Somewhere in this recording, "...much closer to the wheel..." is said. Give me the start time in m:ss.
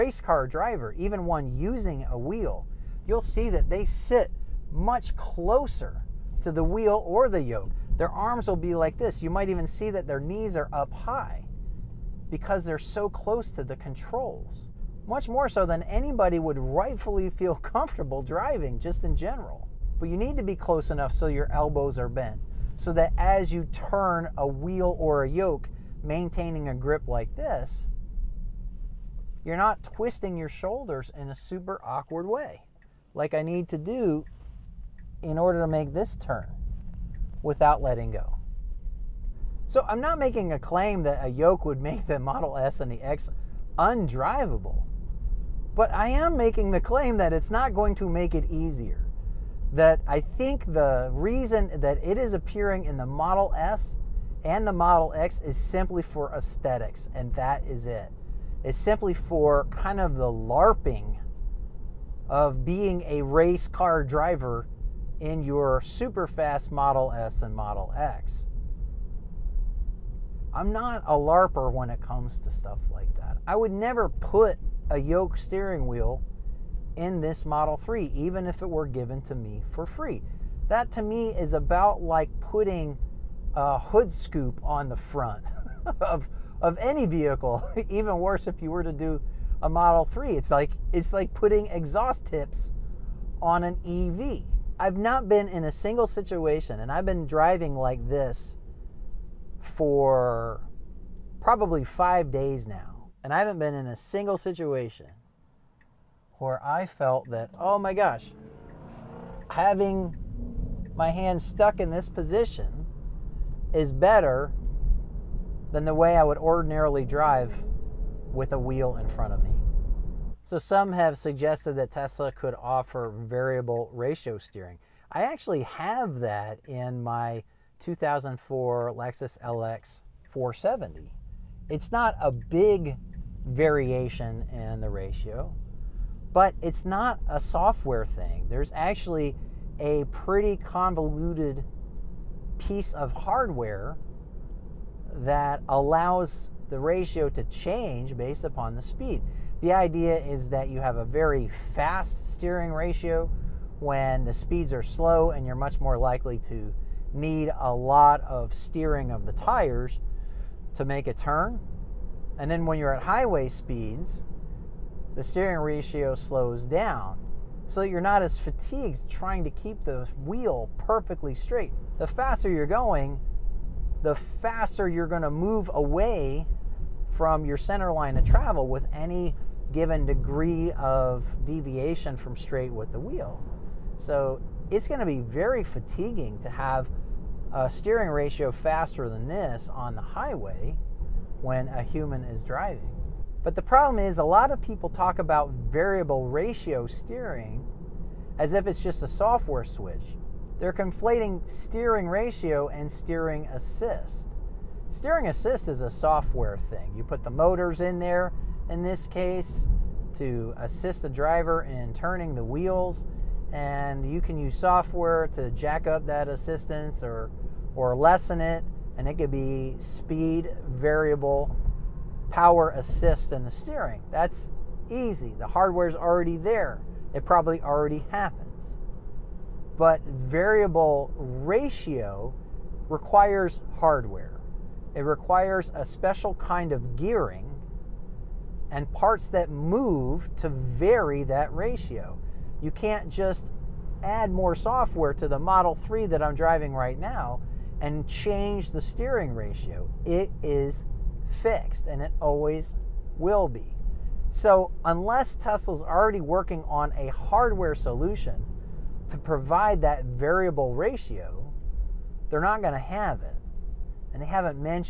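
0:04.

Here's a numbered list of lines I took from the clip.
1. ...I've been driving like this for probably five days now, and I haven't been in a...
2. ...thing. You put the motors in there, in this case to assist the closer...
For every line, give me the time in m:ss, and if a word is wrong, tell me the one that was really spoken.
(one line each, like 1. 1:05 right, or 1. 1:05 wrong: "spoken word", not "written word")
1. 1:36 right
2. 3:26 wrong: "driver", not "closer".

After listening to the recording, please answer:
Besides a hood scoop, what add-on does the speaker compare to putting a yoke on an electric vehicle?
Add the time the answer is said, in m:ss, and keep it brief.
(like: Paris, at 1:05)
Exhaust tips, at 1:31.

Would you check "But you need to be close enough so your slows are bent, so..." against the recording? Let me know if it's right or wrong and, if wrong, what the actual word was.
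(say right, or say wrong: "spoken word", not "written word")
wrong: "elbows", not "slows".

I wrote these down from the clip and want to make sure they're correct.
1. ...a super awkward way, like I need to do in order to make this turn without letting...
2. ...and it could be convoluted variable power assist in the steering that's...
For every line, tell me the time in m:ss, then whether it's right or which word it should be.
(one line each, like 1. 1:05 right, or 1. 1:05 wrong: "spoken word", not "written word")
1. 0:31 right
2. 3:38 wrong: "speed", not "convoluted".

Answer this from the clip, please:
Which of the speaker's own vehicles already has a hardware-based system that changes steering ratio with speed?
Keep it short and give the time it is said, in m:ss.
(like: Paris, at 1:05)
2004 Lexus LX 470, at 2:07.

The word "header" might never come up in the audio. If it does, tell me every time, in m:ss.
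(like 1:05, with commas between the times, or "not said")
not said.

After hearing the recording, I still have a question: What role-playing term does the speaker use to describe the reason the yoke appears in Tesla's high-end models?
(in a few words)
LARPing.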